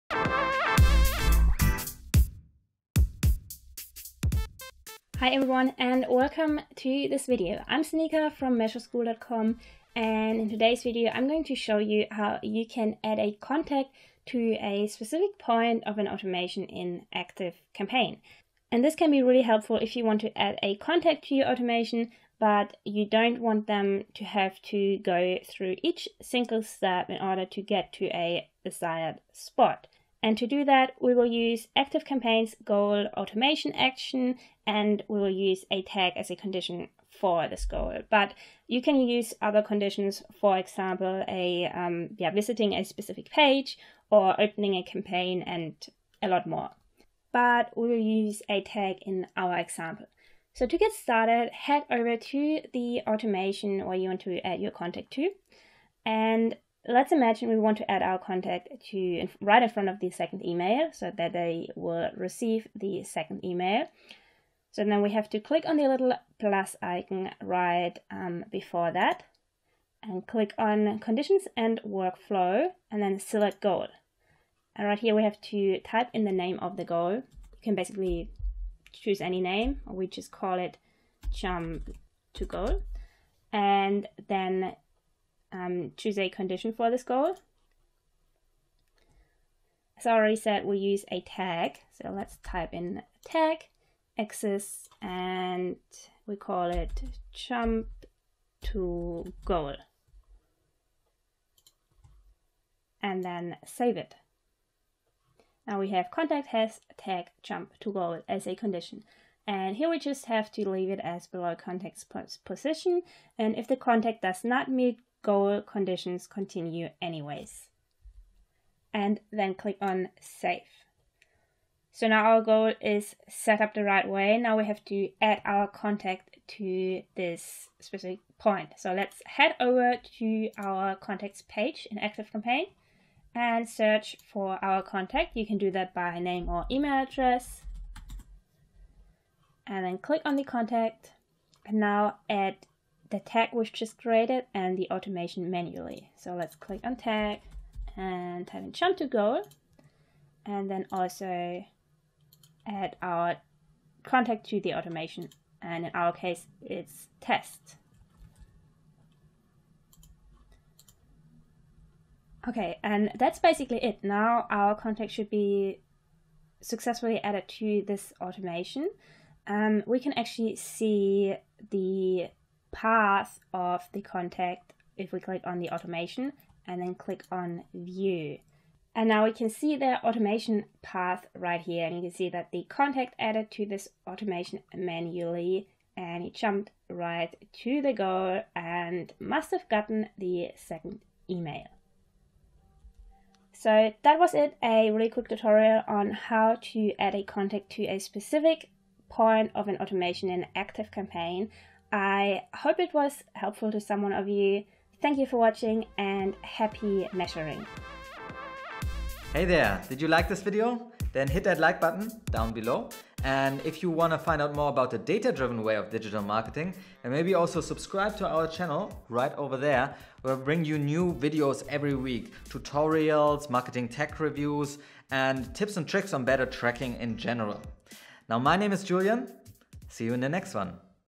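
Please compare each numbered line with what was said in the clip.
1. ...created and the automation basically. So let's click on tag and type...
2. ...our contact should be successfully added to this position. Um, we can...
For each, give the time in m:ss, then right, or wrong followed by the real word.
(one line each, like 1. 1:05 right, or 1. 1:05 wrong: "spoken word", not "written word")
1. 2:23 wrong: "manually", not "basically"
2. 2:44 wrong: "automation", not "position".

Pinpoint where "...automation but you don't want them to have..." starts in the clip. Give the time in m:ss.
0:21.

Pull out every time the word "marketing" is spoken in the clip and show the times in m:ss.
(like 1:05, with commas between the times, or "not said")
3:36, 3:43.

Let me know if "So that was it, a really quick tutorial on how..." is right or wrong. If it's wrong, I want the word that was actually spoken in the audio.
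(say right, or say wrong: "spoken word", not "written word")
right.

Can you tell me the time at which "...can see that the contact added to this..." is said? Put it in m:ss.
3:02.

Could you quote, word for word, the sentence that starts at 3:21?
I hope it was helpful to someone of you.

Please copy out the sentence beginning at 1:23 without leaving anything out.
And then um, choose a condition for this goal.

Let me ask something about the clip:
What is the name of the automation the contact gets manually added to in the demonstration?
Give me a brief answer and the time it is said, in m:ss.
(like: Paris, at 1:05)
test, at 2:37.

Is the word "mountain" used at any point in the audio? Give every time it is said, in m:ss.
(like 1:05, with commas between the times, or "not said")
not said.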